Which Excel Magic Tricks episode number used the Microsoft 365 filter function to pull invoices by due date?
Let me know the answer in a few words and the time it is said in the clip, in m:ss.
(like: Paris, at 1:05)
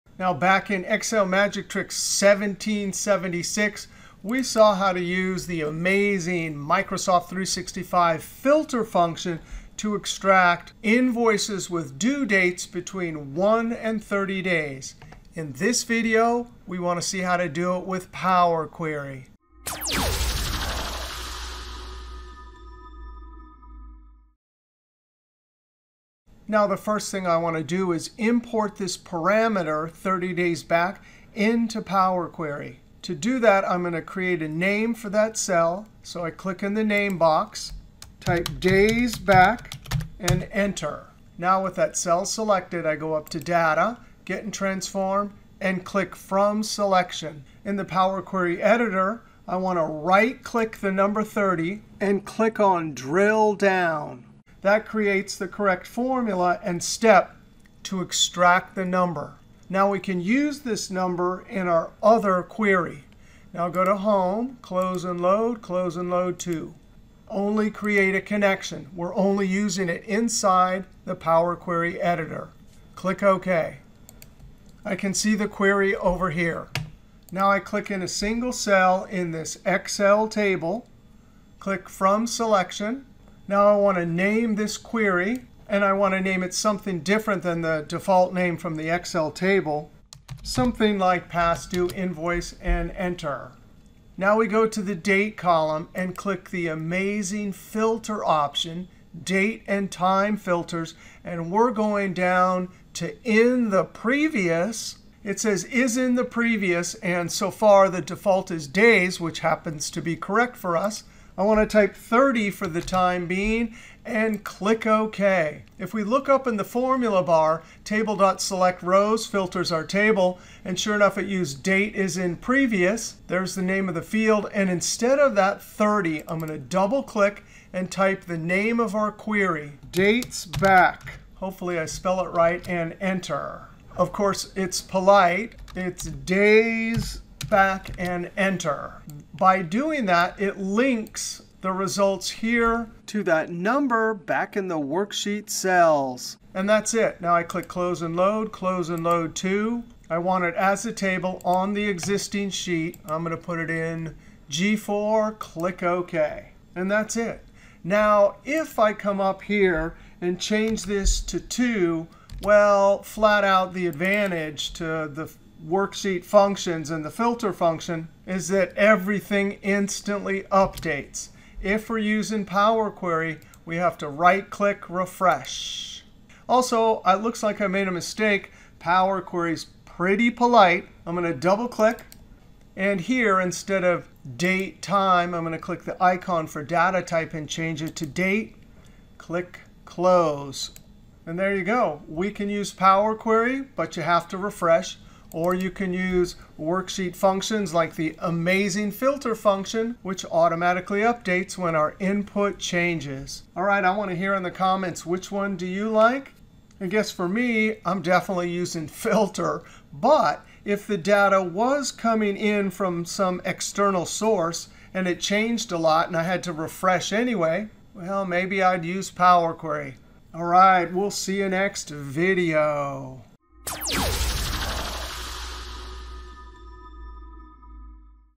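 1776, at 0:02.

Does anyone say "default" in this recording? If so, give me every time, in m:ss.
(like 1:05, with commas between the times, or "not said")
1:27, 1:48.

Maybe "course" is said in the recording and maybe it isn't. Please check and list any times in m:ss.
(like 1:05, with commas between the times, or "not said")
2:14.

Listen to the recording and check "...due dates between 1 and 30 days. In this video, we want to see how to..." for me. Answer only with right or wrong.
right.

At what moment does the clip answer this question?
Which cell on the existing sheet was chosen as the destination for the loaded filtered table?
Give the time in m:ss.
2:34.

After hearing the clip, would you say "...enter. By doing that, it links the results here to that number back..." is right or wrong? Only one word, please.
right.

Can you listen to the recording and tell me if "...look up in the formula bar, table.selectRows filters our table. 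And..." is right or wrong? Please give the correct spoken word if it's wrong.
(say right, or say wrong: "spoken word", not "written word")
right.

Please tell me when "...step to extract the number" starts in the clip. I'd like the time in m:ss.
0:56.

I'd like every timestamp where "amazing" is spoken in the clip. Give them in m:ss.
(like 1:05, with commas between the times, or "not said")
0:05, 1:36, 3:18.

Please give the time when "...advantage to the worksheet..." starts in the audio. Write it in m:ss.
2:43.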